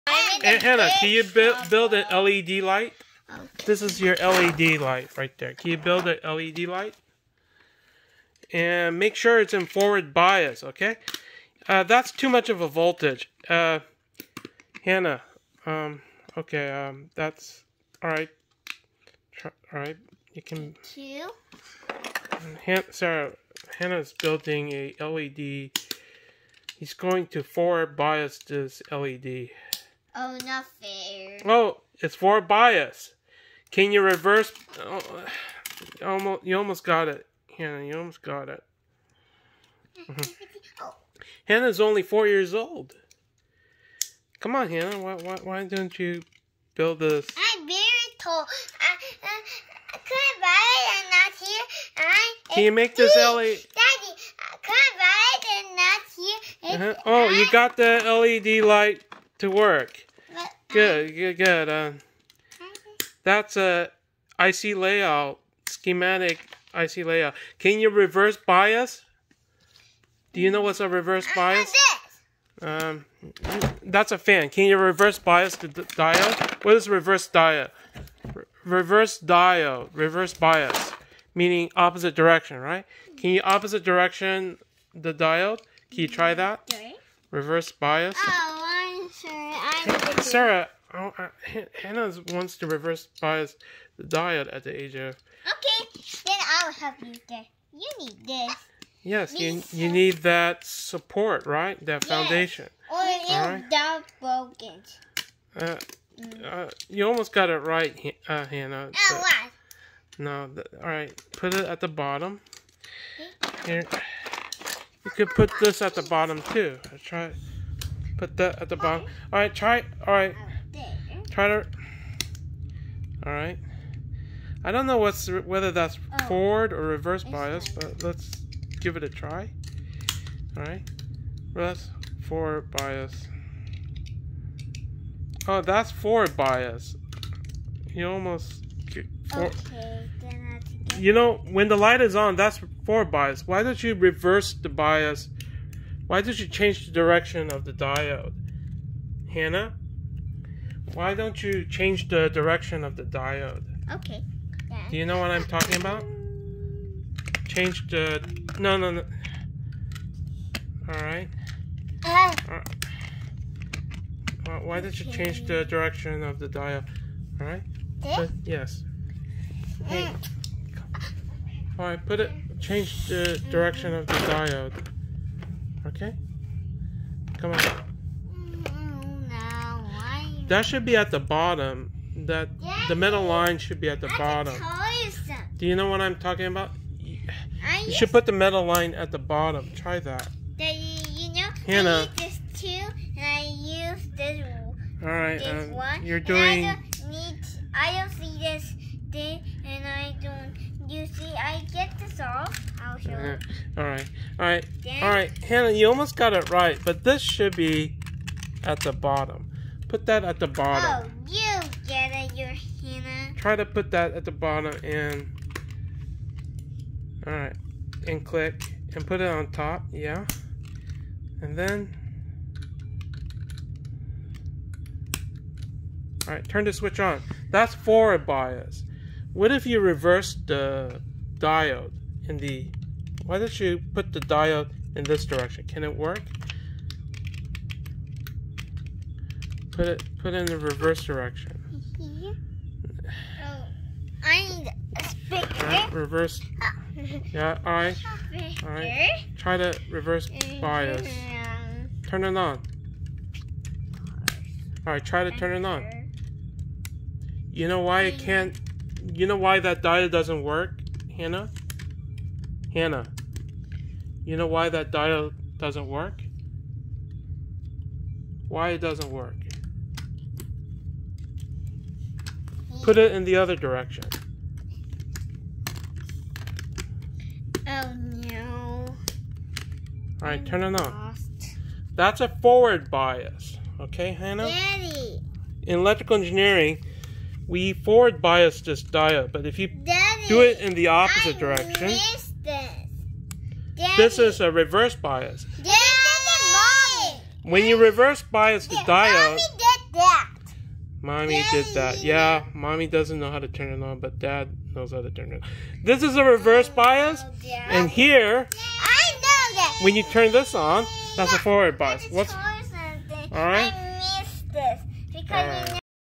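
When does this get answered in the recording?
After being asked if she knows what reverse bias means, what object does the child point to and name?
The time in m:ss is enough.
1:14.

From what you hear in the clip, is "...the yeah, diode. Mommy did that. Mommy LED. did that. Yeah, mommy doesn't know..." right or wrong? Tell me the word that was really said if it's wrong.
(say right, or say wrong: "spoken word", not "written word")
wrong: "Daddy", not "LED".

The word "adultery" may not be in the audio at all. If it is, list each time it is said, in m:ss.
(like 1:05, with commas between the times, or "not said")
not said.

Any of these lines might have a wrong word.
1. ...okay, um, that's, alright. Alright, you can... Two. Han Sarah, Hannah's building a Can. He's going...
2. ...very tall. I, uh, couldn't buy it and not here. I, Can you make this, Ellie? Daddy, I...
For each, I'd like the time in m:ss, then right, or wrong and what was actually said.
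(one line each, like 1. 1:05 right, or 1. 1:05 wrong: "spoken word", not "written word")
1. 0:16 wrong: "LED", not "Can"
2. 0:47 right.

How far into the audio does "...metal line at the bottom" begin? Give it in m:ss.
3:08.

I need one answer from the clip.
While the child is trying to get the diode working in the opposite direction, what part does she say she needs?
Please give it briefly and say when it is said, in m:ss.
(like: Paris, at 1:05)
speaker, at 4:05.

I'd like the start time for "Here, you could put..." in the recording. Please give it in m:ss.
1:53.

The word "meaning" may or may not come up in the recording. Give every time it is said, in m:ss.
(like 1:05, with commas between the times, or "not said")
1:21.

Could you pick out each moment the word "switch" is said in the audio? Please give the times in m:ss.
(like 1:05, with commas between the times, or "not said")
3:46.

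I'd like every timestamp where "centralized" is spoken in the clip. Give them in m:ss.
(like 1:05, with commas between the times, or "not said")
not said.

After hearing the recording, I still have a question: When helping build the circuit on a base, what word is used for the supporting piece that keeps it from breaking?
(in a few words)
foundation.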